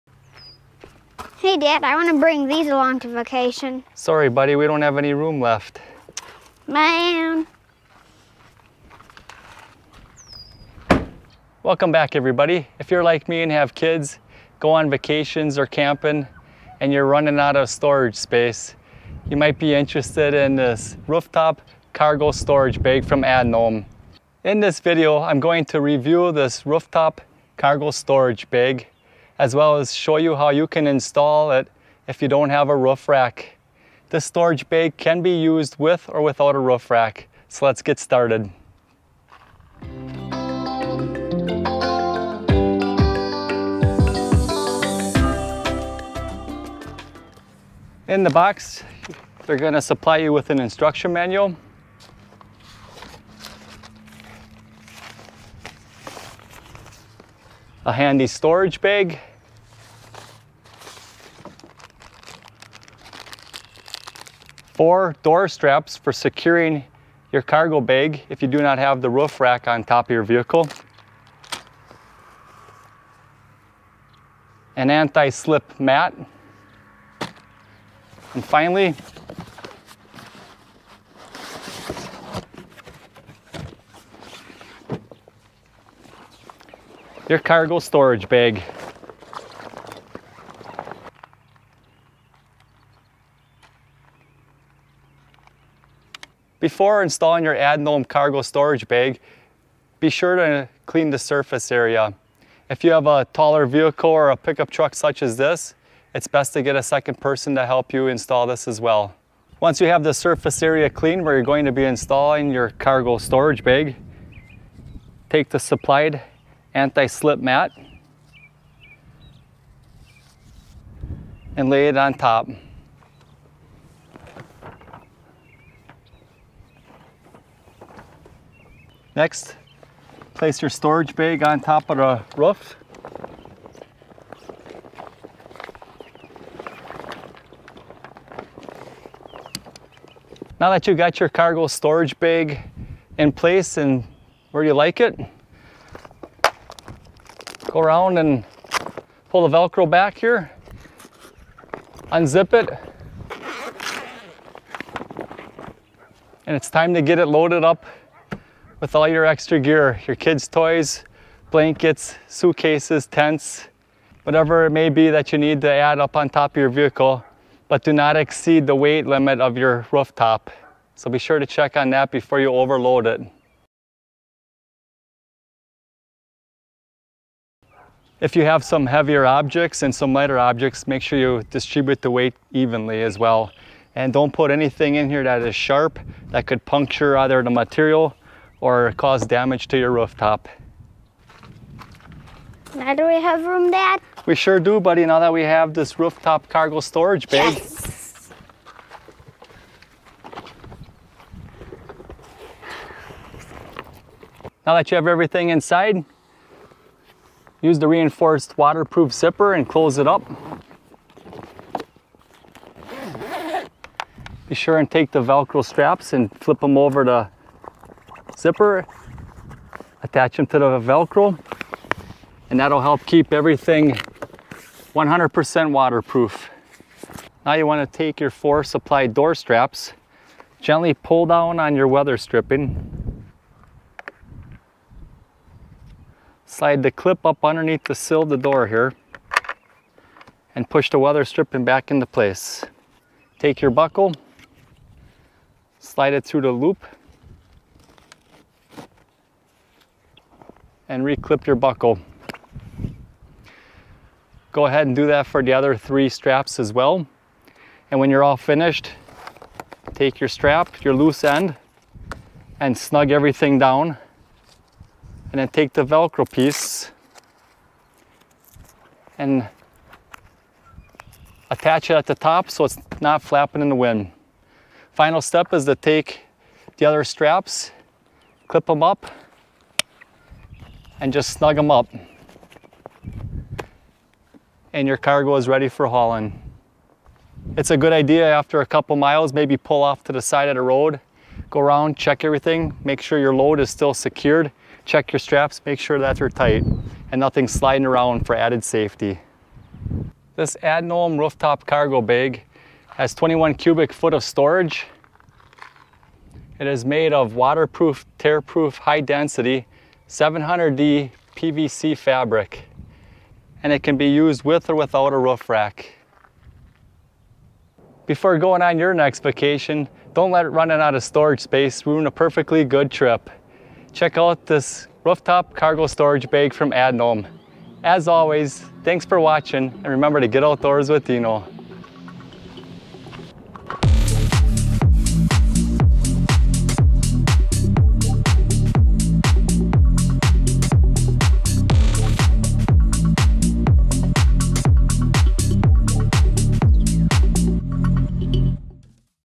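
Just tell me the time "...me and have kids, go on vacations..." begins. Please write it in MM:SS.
00:13.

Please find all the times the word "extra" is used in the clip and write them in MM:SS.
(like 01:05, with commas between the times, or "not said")
02:39.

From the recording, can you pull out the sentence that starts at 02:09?
Next, place your storage bag on top of the roof.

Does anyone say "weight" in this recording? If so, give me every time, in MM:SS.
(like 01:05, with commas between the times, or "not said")
02:48, 03:02.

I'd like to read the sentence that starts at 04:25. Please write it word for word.
And then take the Velcro piece and attach it at the top so it's not flapping in the wind.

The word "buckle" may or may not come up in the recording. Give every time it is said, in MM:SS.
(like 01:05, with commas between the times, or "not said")
04:03, 04:11.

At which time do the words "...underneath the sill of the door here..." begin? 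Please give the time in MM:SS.
03:57.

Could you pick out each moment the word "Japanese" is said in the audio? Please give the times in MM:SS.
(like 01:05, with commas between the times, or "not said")
not said.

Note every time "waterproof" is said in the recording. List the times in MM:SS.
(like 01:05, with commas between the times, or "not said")
03:28, 03:45, 05:07.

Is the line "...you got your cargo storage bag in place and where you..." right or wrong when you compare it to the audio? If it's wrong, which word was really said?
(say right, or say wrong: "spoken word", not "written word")
right.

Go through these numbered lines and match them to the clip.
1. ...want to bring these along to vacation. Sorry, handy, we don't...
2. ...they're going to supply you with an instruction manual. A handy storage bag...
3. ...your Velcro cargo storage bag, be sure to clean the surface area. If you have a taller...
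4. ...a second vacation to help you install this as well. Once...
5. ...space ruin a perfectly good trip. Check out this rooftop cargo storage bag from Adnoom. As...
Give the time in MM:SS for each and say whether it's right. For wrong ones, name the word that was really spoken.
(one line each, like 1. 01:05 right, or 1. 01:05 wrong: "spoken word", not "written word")
1. 00:01 wrong: "buddy", not "handy"
2. 00:49 right
3. 01:37 wrong: "Adnoom", not "Velcro"
4. 01:46 wrong: "person", not "vacation"
5. 05:21 right.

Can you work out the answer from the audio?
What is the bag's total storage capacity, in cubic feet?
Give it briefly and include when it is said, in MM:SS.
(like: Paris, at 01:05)
21, at 05:03.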